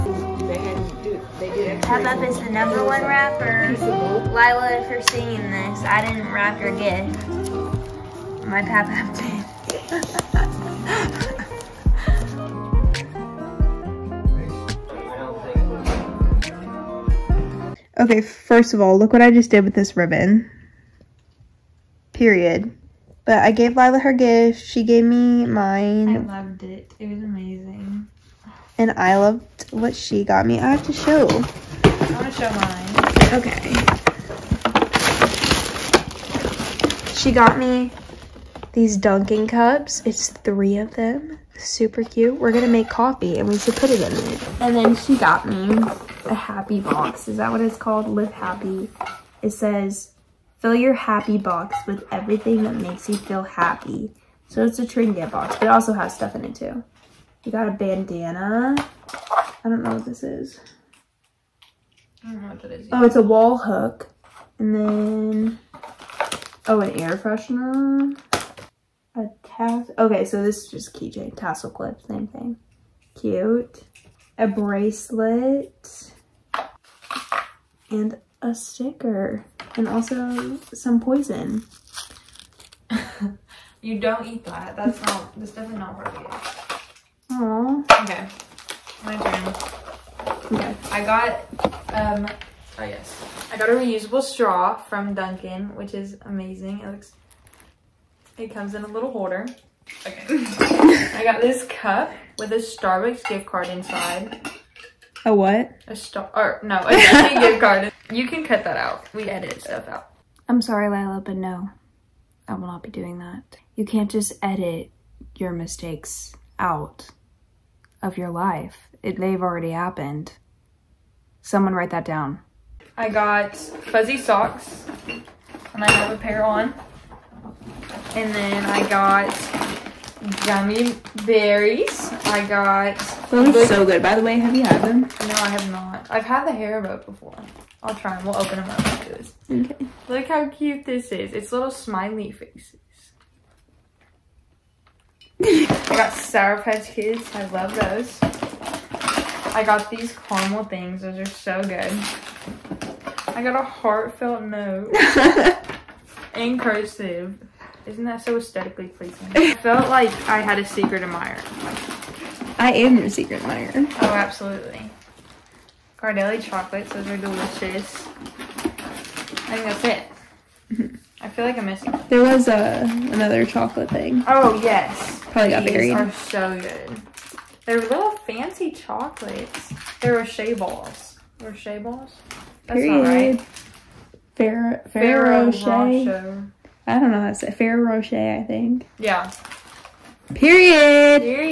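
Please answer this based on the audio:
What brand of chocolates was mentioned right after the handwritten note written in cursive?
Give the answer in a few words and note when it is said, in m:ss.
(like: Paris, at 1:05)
Ghirardelli, at 2:45.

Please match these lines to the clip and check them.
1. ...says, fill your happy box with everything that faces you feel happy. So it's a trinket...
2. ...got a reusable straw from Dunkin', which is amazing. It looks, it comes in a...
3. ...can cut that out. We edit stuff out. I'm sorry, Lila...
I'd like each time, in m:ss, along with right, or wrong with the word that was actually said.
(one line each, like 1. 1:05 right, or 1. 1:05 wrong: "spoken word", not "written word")
1. 0:49 wrong: "makes", not "faces"
2. 1:33 right
3. 1:48 right.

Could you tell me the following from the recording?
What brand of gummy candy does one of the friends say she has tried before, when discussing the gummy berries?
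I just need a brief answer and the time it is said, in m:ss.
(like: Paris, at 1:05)
Haribo, at 2:16.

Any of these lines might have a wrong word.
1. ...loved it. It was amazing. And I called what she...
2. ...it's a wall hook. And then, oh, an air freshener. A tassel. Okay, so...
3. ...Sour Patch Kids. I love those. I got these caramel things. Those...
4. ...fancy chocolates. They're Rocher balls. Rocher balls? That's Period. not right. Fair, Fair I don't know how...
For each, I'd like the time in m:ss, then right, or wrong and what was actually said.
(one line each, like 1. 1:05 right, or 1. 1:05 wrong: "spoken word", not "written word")
1. 0:26 wrong: "loved", not "called"
2. 1:03 right
3. 2:26 right
4. 2:58 right.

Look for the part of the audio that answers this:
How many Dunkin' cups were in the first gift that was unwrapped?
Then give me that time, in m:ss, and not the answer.
0:40.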